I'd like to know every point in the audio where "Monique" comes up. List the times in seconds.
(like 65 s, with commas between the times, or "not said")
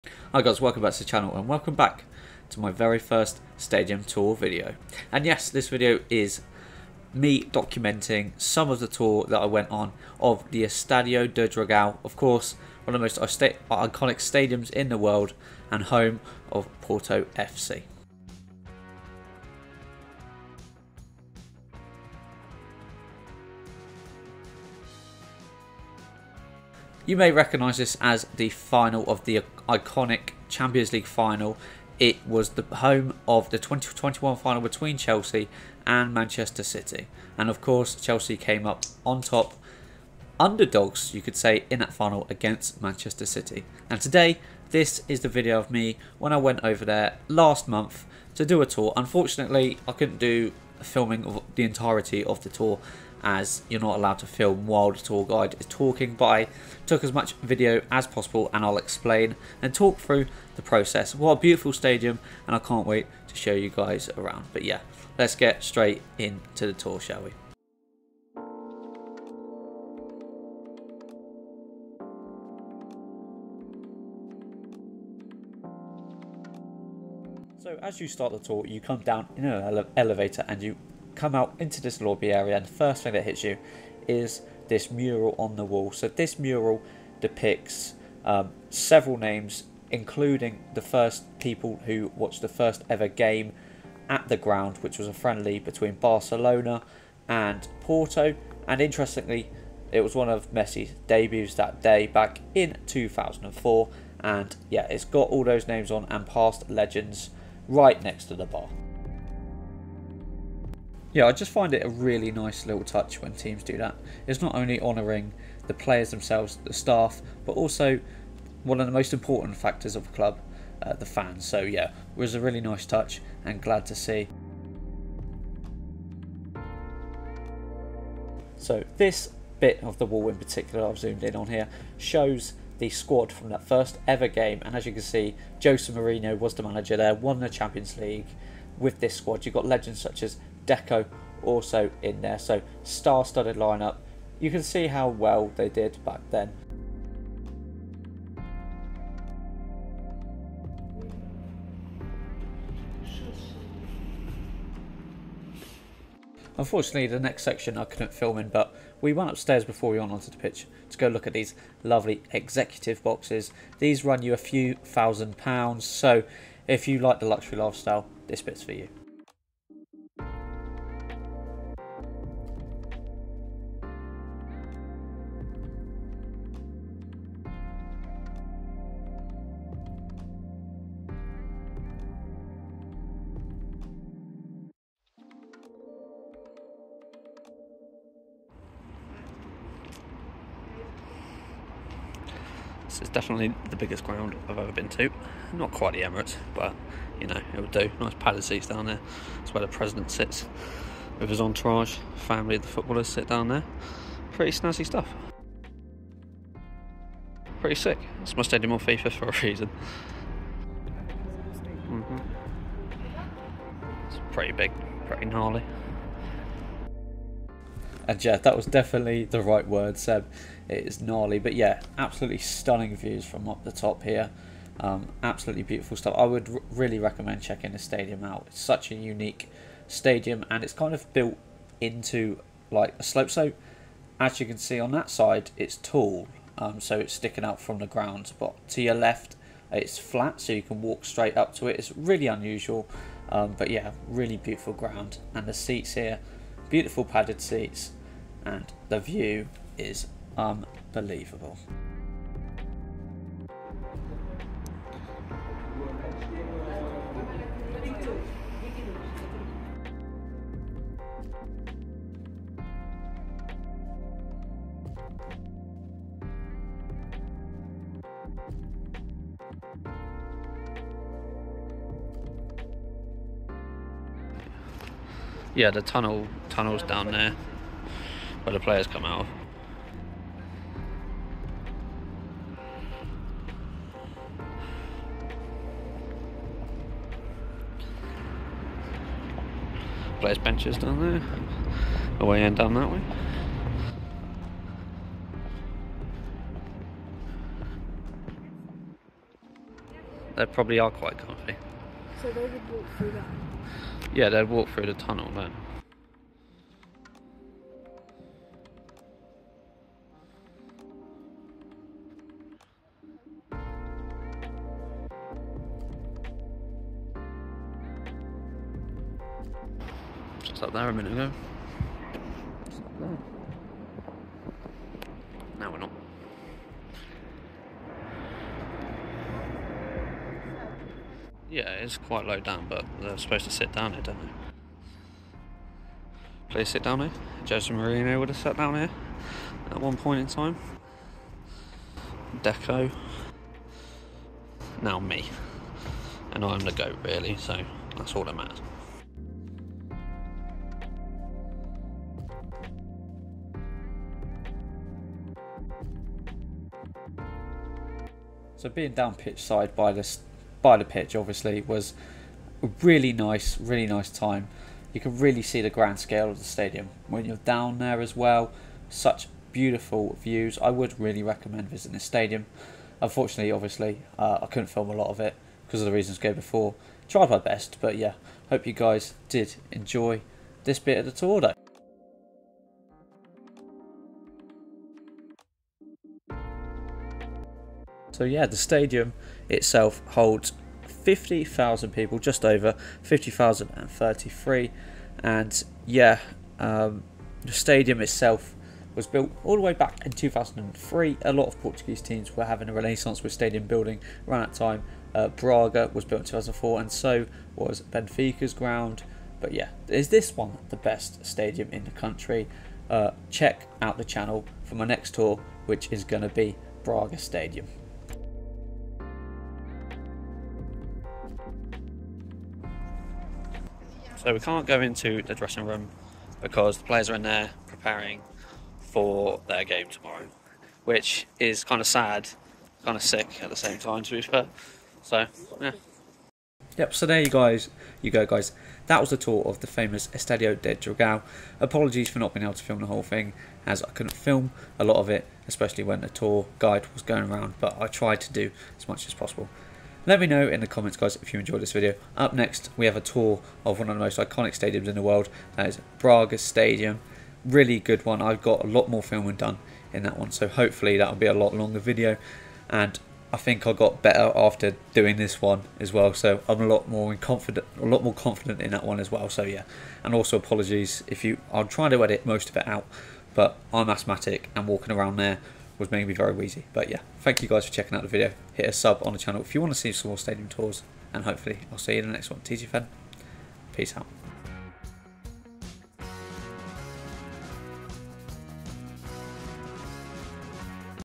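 not said.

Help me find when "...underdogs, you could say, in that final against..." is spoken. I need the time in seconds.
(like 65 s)
40 s.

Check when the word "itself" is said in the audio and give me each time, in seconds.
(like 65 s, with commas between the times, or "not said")
389 s, 398 s.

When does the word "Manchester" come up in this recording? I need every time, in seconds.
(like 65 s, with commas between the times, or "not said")
36 s, 42 s.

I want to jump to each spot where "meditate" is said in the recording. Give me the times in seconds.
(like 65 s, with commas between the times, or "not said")
not said.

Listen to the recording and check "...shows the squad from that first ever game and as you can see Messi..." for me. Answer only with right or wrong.
wrong.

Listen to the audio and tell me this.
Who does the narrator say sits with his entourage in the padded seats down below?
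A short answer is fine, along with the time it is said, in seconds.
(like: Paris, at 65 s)
The president, at 199 s.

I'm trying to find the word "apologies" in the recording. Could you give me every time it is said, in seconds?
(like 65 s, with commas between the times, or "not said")
441 s, 470 s.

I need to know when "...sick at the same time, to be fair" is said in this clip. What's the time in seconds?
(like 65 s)
433 s.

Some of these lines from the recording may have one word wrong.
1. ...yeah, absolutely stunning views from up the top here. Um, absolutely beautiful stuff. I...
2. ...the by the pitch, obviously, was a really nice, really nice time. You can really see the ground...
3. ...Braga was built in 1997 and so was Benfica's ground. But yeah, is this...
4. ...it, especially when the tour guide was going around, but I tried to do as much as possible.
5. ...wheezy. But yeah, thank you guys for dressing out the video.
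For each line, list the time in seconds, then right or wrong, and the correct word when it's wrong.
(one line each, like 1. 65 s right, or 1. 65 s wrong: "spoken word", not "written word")
1. 221 s right
2. 359 s wrong: "grand", not "ground"
3. 405 s wrong: "2004", not "1997"
4. 445 s right
5. 476 s wrong: "checking", not "dressing".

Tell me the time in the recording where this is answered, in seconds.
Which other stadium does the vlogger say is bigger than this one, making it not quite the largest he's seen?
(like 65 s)
195 s.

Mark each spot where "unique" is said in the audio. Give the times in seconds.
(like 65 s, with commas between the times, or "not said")
228 s.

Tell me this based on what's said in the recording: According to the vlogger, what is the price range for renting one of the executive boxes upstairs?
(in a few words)
A few thousand pounds.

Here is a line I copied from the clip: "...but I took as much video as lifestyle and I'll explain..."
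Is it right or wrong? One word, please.
wrong.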